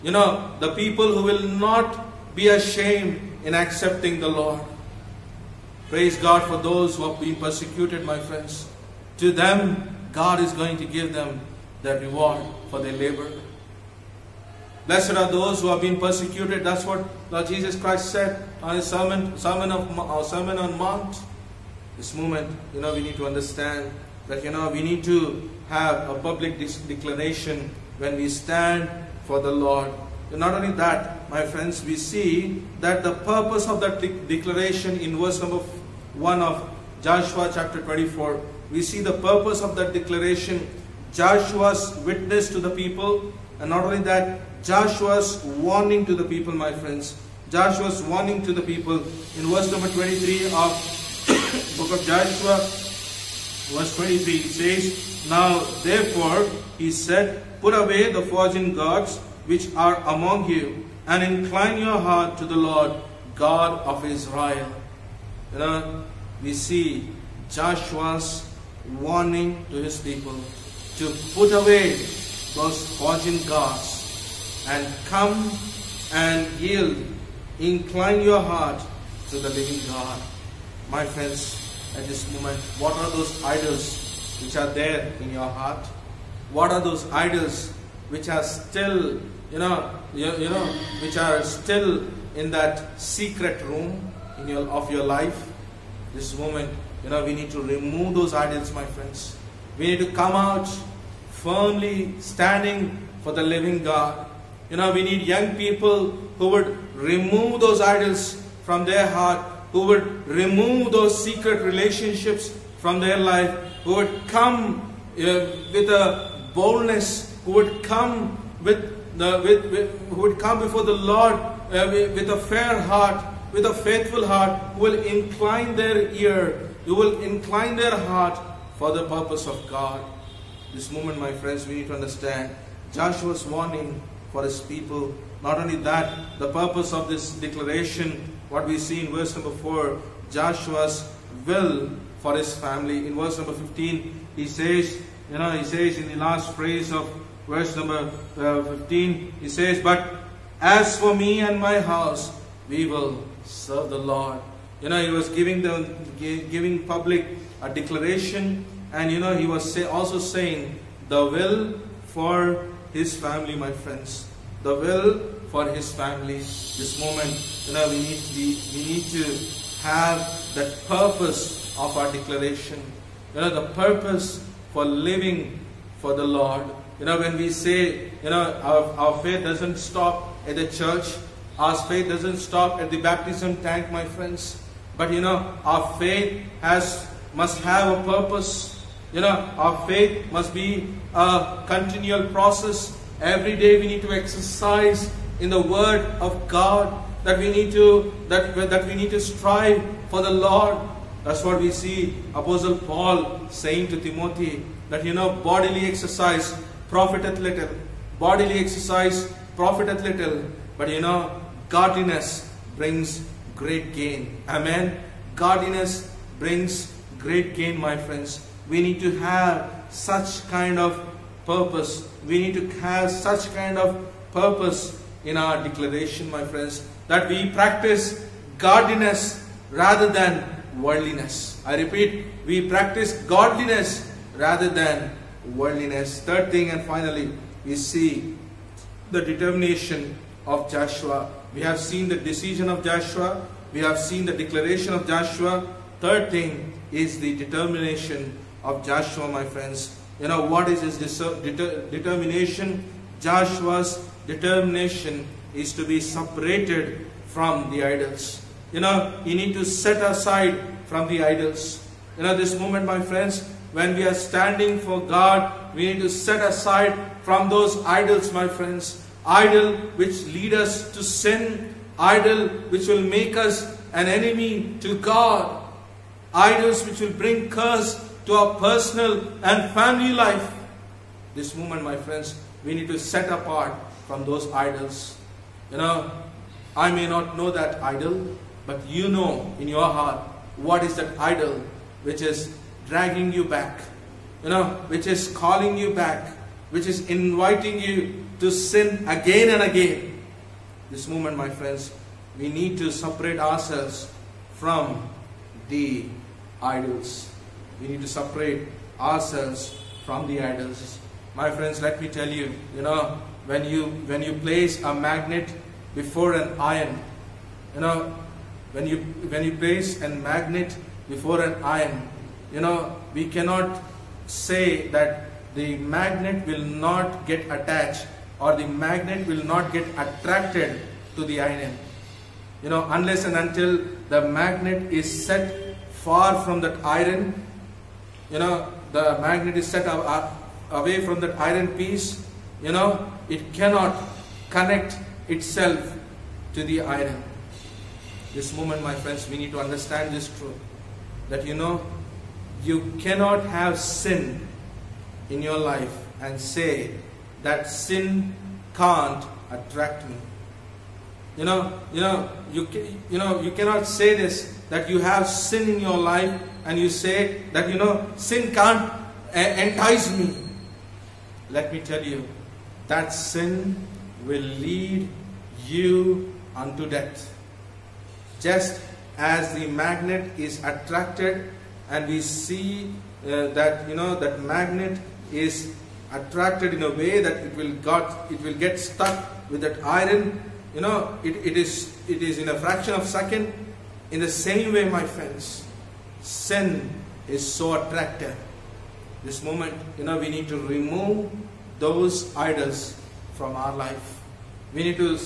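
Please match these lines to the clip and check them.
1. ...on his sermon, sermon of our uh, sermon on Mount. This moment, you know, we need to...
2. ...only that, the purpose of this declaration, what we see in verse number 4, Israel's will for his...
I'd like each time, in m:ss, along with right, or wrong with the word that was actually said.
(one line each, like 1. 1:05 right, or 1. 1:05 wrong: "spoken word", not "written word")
1. 0:18 right
2. 2:15 wrong: "Joshua", not "Israel".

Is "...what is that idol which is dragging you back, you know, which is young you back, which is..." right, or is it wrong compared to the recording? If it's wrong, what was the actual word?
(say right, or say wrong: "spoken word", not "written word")
wrong: "calling", not "young".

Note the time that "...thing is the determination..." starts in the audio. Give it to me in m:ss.
4:06.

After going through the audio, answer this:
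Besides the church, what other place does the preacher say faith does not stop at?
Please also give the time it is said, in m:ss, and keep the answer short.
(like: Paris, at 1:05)
The baptism tank, at 3:02.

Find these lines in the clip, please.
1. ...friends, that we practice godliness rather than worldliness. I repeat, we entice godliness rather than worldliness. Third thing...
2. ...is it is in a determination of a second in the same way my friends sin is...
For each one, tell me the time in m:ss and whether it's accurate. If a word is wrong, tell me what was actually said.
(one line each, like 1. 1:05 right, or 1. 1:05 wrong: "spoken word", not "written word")
1. 3:46 wrong: "practice", not "entice"
2. 6:31 wrong: "fraction", not "determination".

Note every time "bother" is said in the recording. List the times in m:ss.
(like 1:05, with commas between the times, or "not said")
not said.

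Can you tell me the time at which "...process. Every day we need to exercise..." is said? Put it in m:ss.
3:12.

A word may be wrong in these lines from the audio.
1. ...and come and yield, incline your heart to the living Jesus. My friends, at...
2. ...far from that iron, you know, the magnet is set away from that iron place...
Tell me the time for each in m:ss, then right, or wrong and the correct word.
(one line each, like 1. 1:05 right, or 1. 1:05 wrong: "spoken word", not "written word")
1. 1:14 wrong: "God", not "Jesus"
2. 5:35 wrong: "piece", not "place".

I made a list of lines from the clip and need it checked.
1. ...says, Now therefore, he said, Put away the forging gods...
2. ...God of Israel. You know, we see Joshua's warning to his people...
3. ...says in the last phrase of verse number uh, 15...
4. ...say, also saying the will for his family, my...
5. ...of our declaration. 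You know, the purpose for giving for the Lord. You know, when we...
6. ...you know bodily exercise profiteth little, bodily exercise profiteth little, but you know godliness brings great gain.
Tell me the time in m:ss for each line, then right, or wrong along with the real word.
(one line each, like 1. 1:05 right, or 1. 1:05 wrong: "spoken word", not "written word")
1. 0:54 right
2. 1:03 right
3. 2:25 right
4. 2:39 right
5. 2:51 wrong: "living", not "giving"
6. 3:25 right.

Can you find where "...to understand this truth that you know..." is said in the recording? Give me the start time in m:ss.
5:49.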